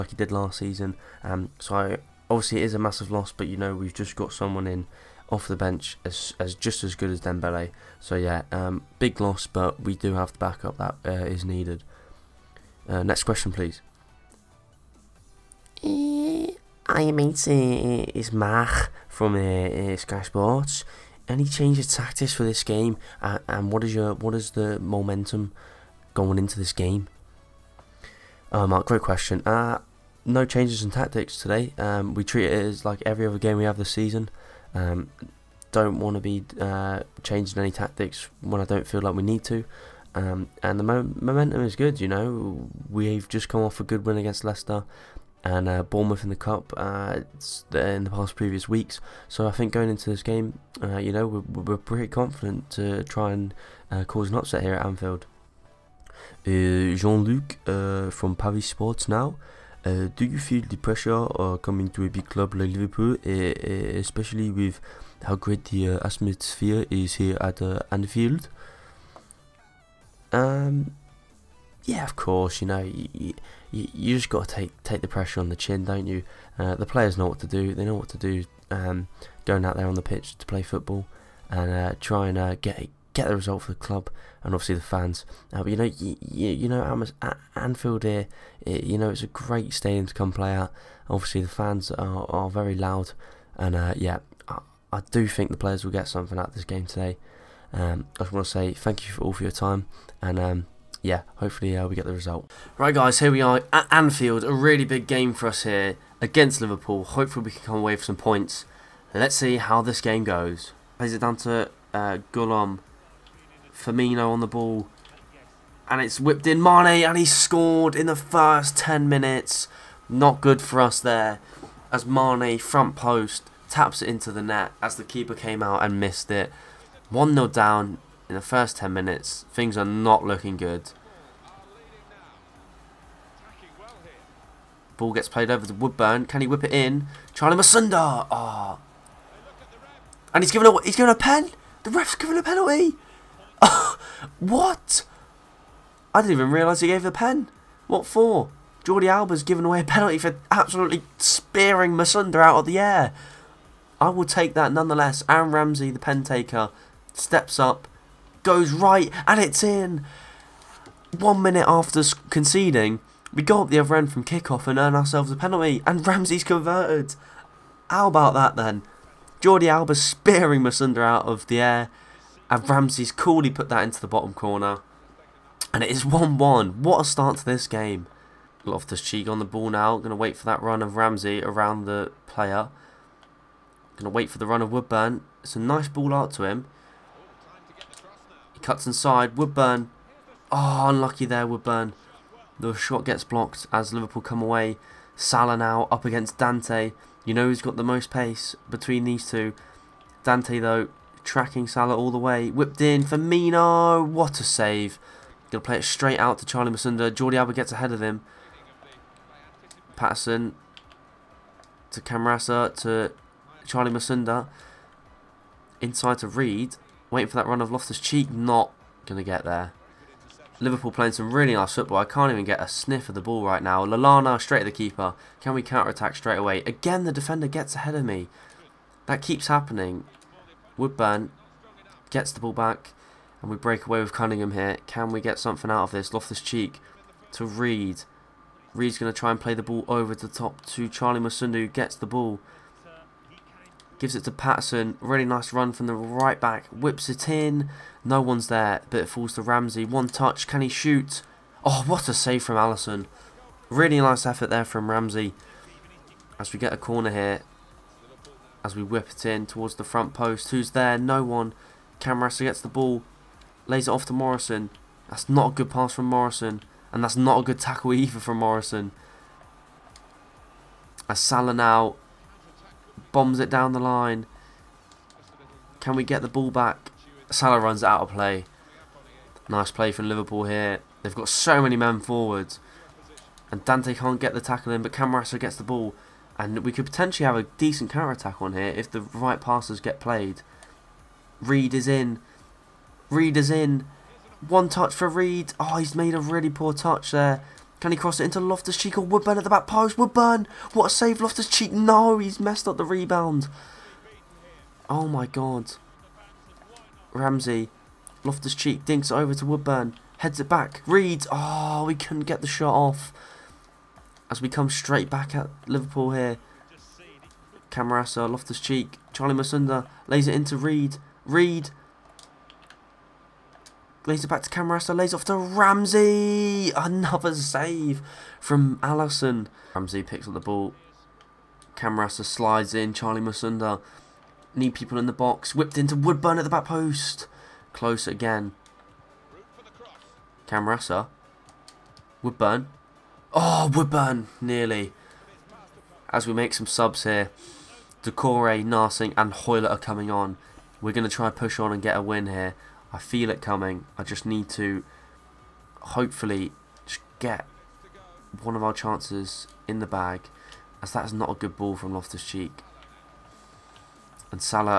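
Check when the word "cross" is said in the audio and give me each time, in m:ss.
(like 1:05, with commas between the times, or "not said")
4:57.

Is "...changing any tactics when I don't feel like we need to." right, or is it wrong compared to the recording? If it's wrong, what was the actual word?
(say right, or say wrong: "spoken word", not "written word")
right.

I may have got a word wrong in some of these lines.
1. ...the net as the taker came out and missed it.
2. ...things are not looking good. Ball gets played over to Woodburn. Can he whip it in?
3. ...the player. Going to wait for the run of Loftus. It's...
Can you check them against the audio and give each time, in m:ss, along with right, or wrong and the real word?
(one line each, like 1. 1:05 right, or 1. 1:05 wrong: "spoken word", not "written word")
1. 2:04 wrong: "keeper", not "taker"
2. 2:09 right
3. 3:01 wrong: "Woodburn", not "Loftus".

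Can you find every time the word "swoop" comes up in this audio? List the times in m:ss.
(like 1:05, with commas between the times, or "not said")
not said.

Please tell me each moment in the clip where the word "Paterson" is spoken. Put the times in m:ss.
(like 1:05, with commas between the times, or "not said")
3:29, 4:04.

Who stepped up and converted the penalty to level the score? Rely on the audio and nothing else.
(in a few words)
Aaron Ramsey.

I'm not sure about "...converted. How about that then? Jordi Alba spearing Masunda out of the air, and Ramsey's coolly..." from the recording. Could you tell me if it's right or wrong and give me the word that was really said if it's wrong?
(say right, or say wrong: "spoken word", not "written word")
right.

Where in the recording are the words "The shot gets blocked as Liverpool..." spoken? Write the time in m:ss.
3:12.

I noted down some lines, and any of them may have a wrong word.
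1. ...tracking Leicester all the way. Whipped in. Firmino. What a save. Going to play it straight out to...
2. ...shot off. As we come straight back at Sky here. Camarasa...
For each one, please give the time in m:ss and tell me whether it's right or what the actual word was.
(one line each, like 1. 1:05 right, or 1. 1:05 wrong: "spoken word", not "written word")
1. 3:21 wrong: "Salah", not "Leicester"
2. 5:12 wrong: "Liverpool", not "Sky".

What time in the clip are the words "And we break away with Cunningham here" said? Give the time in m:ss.
3:53.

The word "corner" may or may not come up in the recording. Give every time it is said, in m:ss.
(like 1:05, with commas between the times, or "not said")
2:54, 4:16.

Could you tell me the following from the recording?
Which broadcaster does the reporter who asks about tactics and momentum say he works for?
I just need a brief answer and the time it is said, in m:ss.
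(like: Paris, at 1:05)
Sky Sports, at 0:19.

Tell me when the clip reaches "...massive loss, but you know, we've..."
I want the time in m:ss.
0:02.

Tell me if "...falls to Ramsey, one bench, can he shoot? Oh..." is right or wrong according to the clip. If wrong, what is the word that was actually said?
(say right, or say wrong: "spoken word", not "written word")
wrong: "touch", not "bench".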